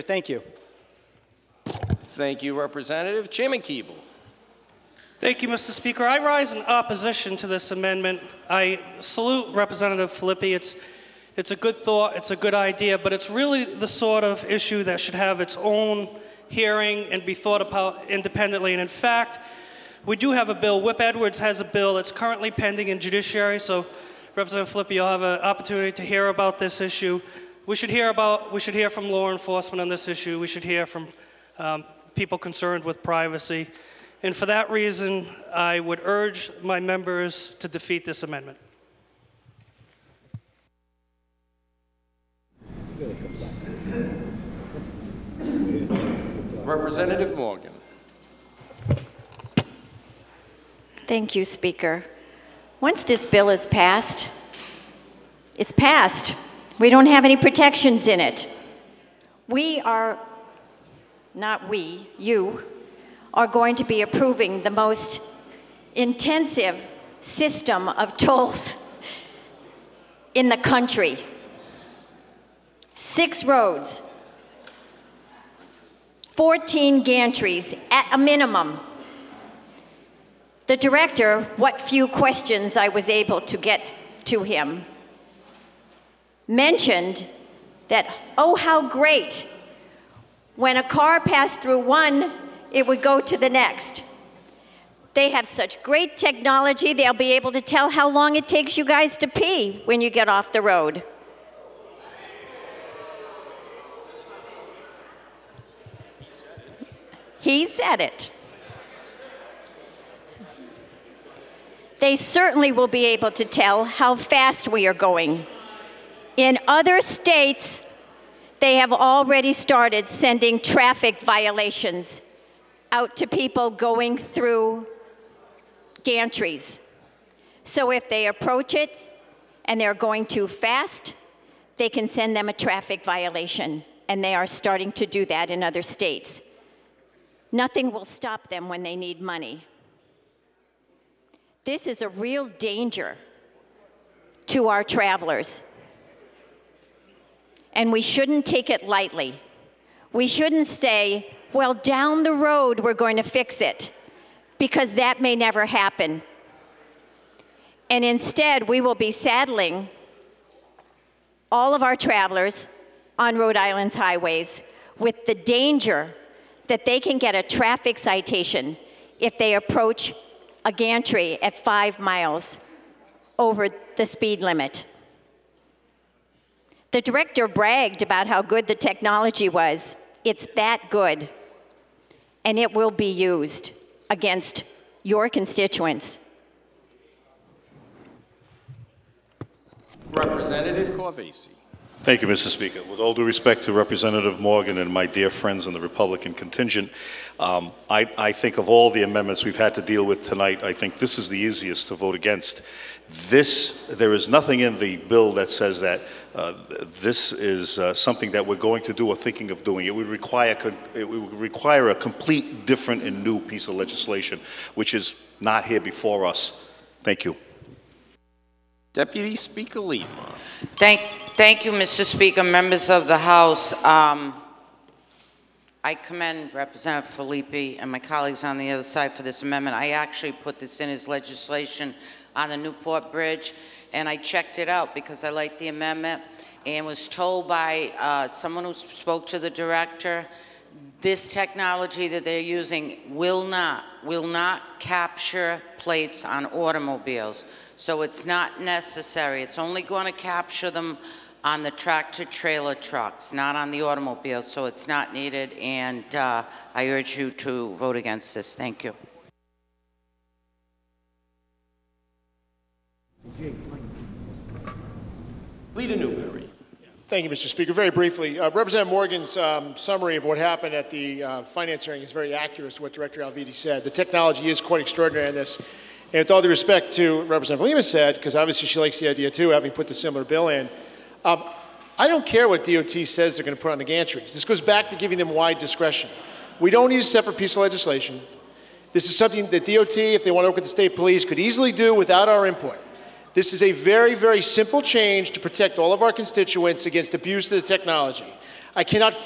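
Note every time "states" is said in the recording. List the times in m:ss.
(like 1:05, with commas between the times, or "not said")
1:56, 2:15, 4:50.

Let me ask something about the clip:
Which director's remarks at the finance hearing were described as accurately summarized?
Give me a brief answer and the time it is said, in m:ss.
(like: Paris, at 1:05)
Alviti, at 4:32.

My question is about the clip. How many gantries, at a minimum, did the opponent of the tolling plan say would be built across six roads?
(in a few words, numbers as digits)
14.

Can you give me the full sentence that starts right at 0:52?
Once this bill is passed, it's passed.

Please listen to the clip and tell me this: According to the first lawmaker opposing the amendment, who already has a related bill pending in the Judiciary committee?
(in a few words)
Whip Edwards.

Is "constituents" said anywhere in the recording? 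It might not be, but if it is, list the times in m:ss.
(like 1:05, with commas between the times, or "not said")
3:05, 4:56.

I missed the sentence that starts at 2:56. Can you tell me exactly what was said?
The director bragged about how good the technology was.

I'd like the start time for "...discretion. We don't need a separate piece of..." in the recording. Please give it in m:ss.
4:45.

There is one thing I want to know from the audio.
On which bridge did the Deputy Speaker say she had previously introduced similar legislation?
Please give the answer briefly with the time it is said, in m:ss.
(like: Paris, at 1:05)
Newport Bridge, at 3:52.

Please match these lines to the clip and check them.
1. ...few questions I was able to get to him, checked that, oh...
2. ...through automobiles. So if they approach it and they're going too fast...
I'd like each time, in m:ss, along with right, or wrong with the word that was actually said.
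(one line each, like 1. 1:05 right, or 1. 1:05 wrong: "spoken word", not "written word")
1. 1:21 wrong: "mentioned", not "checked"
2. 2:04 wrong: "gantries", not "automobiles".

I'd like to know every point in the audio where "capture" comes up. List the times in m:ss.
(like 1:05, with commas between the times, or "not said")
4:04, 4:10.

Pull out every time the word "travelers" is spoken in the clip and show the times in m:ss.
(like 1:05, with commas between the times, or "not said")
2:24, 2:41.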